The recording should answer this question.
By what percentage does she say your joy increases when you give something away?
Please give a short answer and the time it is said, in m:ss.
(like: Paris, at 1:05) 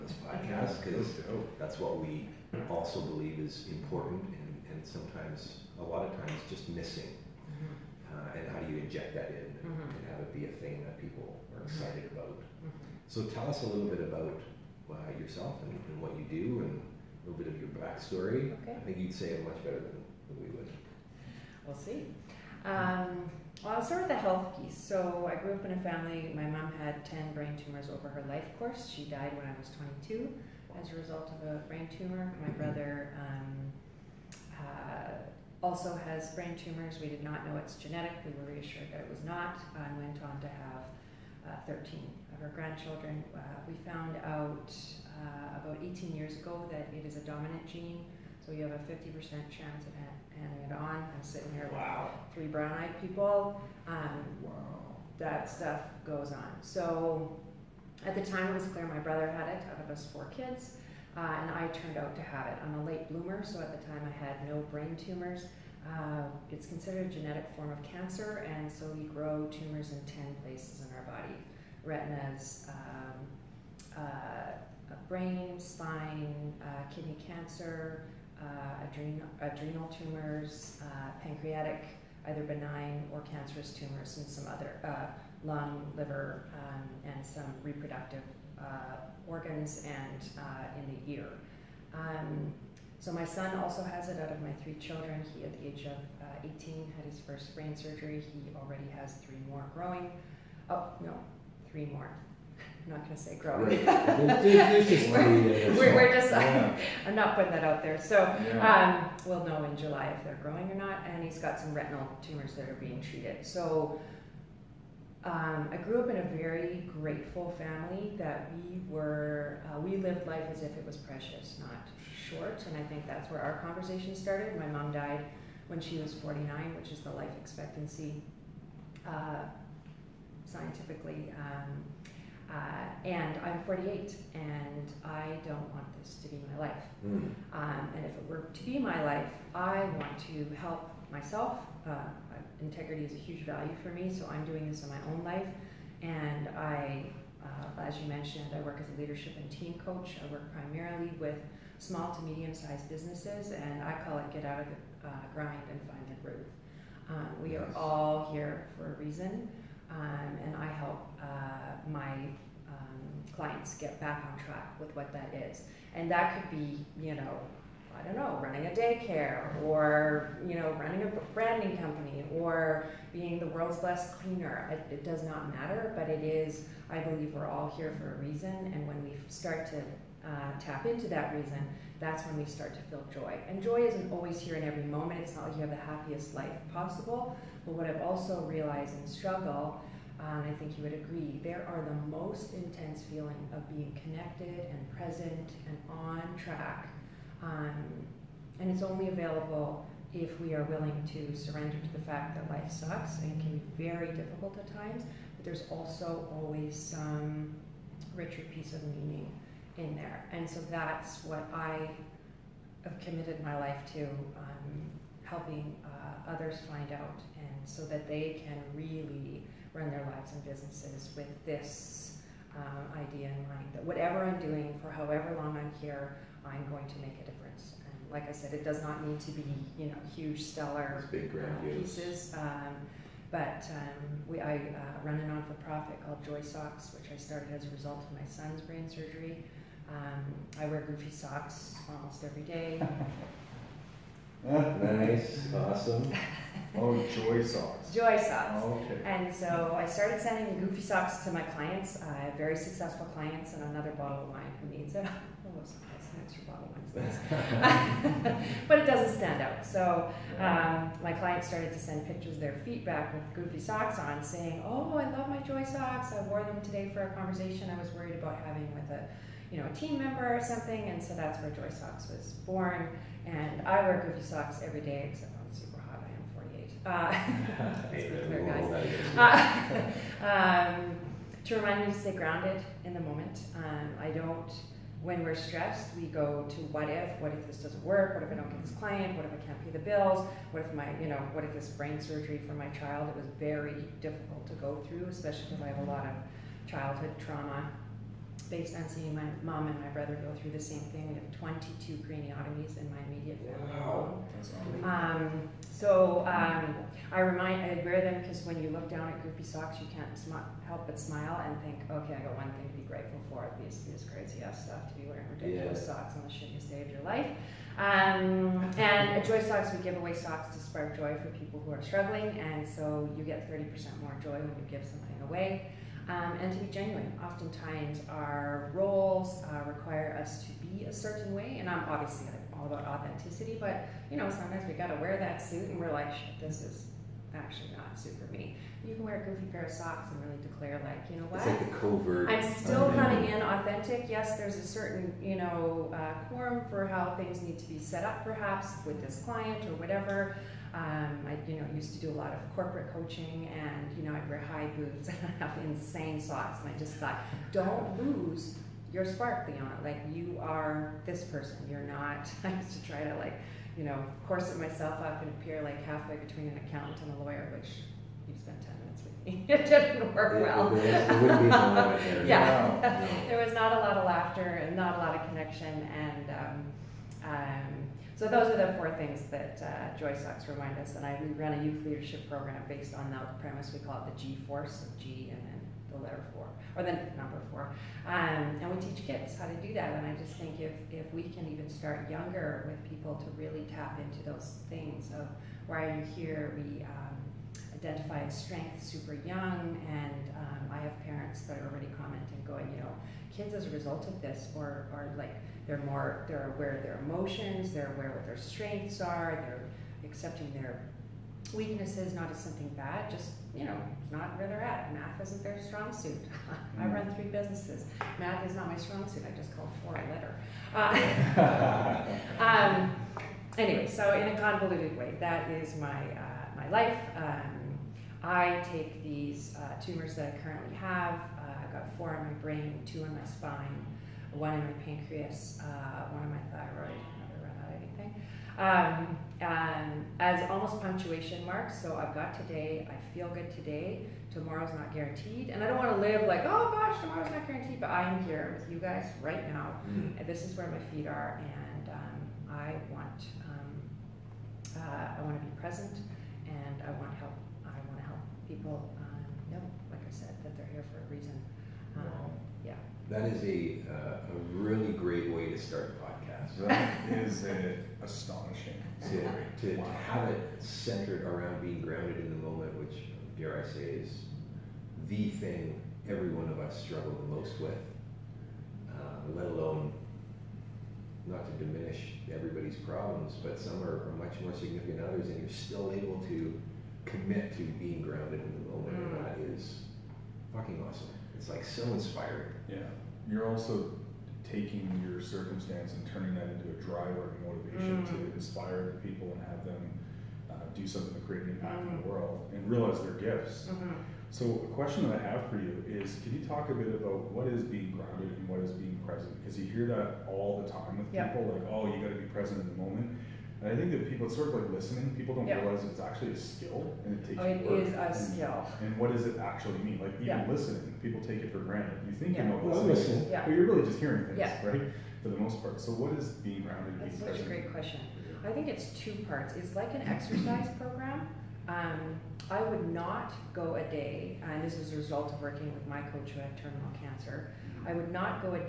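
30%, at 5:23.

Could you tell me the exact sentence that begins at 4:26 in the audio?
I wore them today for a conversation I was worried about having with a." you know, a team member or something.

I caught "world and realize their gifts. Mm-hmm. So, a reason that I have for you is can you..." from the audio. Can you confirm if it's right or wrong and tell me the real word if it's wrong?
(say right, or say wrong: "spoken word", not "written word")
wrong: "question", not "reason".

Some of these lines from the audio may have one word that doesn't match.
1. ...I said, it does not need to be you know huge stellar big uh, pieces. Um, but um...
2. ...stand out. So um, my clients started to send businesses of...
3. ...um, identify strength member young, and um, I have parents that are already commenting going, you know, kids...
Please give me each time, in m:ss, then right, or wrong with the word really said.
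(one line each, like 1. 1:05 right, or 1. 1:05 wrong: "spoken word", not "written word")
1. 3:48 right
2. 4:19 wrong: "pictures", not "businesses"
3. 6:36 wrong: "super", not "member".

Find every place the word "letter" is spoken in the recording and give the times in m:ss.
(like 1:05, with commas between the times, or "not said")
6:26, 7:00.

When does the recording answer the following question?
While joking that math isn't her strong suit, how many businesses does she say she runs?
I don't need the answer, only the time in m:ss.
6:57.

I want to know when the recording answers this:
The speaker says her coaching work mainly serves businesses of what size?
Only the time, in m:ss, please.
2:31.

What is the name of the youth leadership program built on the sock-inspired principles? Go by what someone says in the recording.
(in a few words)
G Force.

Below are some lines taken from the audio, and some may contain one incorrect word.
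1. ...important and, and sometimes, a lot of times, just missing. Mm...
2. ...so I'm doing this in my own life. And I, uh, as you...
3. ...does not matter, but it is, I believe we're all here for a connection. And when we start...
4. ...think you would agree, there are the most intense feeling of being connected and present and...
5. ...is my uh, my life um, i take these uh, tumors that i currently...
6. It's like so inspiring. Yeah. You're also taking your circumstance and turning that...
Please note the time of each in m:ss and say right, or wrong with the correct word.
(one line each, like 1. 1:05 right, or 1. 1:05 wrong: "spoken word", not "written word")
1. 0:03 right
2. 2:24 right
3. 2:55 wrong: "reason", not "connection"
4. 3:10 right
5. 7:05 right
6. 8:11 right.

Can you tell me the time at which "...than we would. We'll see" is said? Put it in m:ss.
0:19.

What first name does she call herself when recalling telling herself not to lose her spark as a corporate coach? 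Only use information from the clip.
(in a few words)
Leon.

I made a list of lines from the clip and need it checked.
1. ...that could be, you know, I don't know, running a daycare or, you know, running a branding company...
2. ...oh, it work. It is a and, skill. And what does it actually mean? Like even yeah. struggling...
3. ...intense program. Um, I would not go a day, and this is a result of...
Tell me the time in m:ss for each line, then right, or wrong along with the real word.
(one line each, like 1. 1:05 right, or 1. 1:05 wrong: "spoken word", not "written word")
1. 2:46 right
2. 8:37 wrong: "listening", not "struggling"
3. 8:50 wrong: "exercise", not "intense".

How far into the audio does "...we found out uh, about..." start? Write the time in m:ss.
0:43.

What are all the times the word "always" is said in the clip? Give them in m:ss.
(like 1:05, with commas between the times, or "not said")
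3:04, 3:26.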